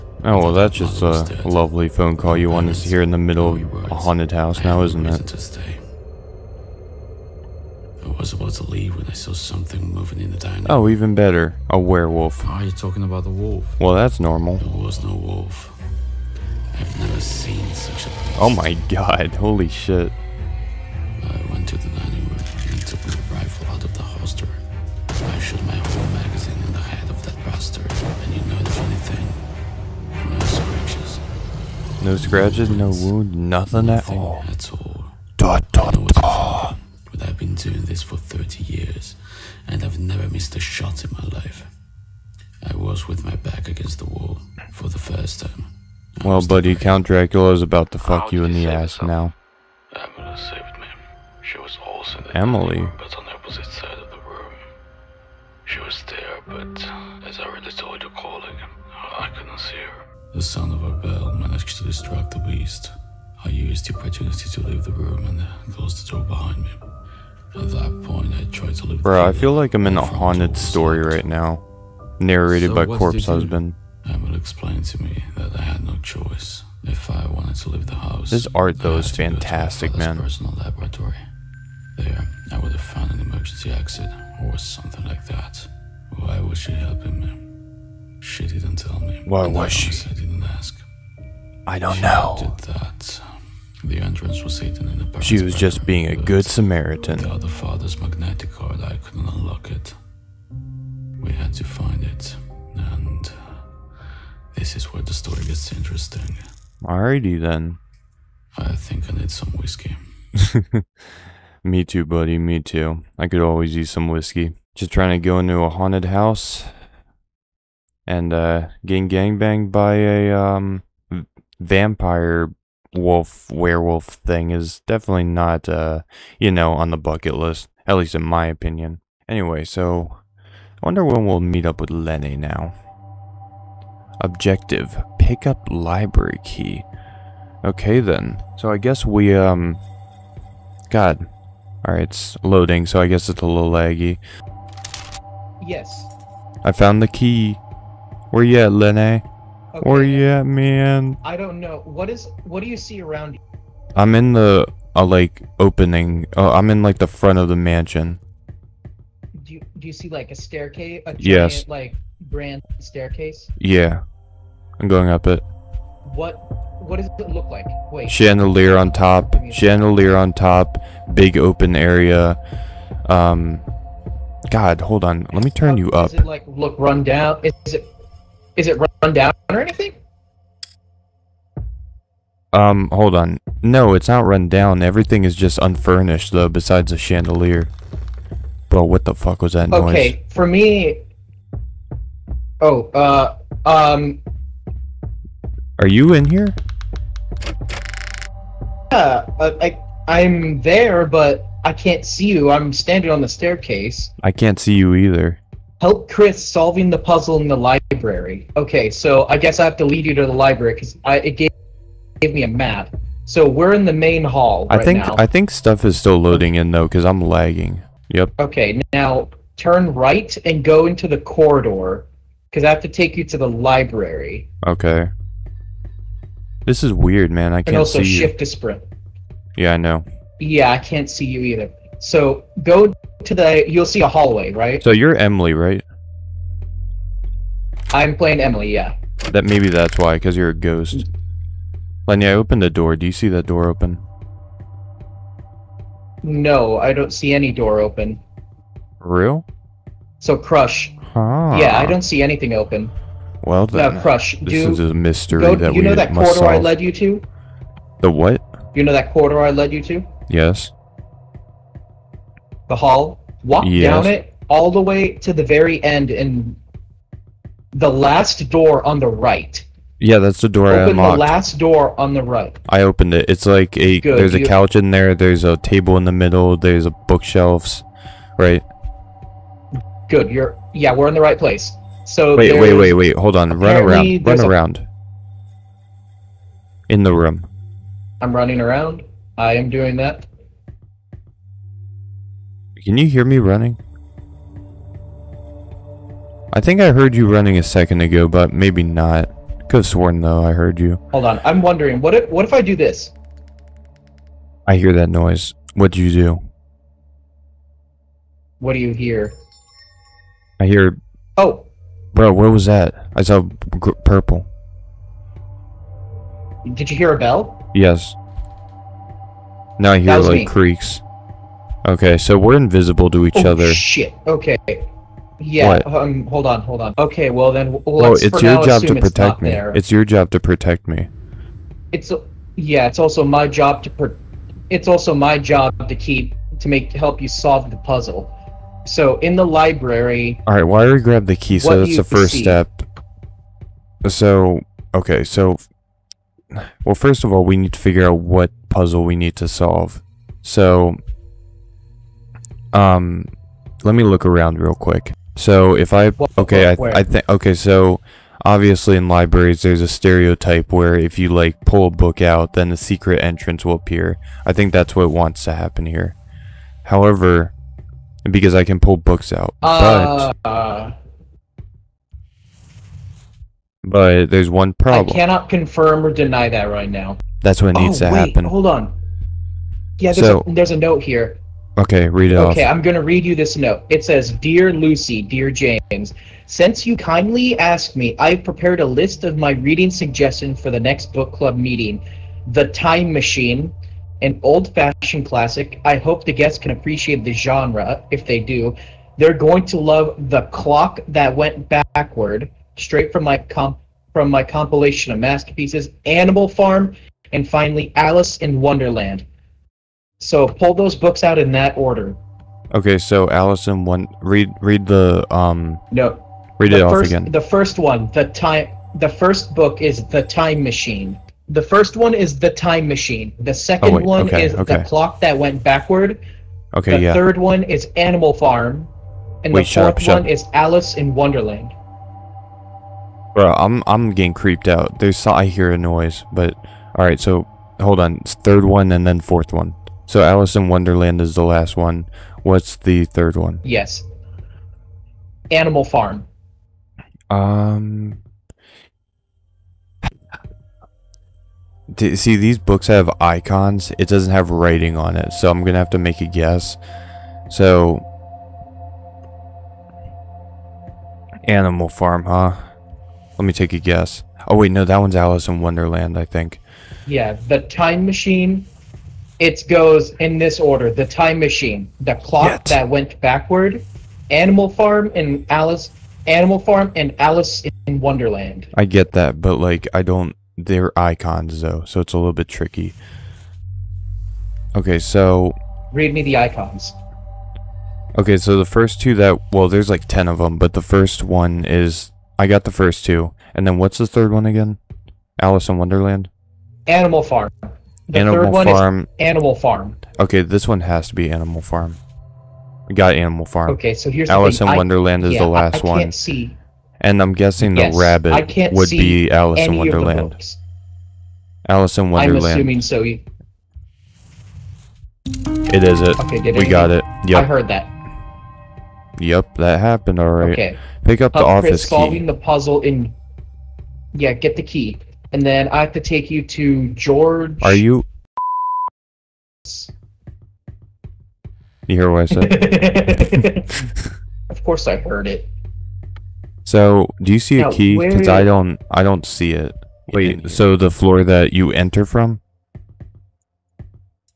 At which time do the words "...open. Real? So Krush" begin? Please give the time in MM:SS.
04:07.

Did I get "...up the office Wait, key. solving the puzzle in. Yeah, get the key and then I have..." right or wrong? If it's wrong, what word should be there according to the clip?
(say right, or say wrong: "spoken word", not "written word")
wrong: "Chris", not "Wait".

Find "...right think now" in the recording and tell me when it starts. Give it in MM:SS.
03:34.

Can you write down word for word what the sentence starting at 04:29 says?
Yeah, that's the door Open I unlocked.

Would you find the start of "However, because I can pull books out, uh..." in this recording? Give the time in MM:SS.
06:06.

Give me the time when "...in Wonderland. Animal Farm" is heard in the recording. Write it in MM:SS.
08:15.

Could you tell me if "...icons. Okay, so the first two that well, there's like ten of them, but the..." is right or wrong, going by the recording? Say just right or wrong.
right.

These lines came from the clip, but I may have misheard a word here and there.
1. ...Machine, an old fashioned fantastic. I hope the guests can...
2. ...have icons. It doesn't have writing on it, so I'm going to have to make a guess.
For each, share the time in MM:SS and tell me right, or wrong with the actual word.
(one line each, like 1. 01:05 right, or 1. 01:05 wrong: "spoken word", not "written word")
1. 06:33 wrong: "classic", not "fantastic"
2. 07:32 right.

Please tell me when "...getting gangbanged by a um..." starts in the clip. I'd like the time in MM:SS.
01:58.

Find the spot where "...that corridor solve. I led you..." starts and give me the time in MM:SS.
04:15.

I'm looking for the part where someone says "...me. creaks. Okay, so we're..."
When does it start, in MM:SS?
05:20.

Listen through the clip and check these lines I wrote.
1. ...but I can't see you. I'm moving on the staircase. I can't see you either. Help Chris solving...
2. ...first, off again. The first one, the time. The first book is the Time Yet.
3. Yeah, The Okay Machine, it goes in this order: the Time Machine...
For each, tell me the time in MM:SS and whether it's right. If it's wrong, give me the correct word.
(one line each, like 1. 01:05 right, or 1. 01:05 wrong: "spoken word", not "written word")
1. 03:21 wrong: "standing", not "moving"
2. 06:56 wrong: "Machine", not "Yet"
3. 07:47 wrong: "Time", not "Okay".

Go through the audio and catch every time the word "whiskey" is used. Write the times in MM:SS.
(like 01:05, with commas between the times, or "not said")
01:49, 01:54.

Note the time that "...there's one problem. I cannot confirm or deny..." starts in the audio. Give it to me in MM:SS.
06:14.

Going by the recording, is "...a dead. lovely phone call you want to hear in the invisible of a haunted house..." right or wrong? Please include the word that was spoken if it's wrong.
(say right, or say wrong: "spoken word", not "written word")
wrong: "middle", not "invisible".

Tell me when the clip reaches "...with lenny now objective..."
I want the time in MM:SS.
02:11.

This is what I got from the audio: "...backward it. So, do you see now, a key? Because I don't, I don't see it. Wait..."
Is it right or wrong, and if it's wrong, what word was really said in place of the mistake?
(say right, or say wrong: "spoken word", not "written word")
wrong: "heard", not "backward".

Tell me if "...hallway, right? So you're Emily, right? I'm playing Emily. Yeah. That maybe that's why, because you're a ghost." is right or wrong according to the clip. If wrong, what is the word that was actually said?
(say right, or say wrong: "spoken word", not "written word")
right.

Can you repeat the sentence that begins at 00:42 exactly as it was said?
I was with my back against the wall for the first time.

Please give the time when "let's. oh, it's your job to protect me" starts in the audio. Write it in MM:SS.
05:27.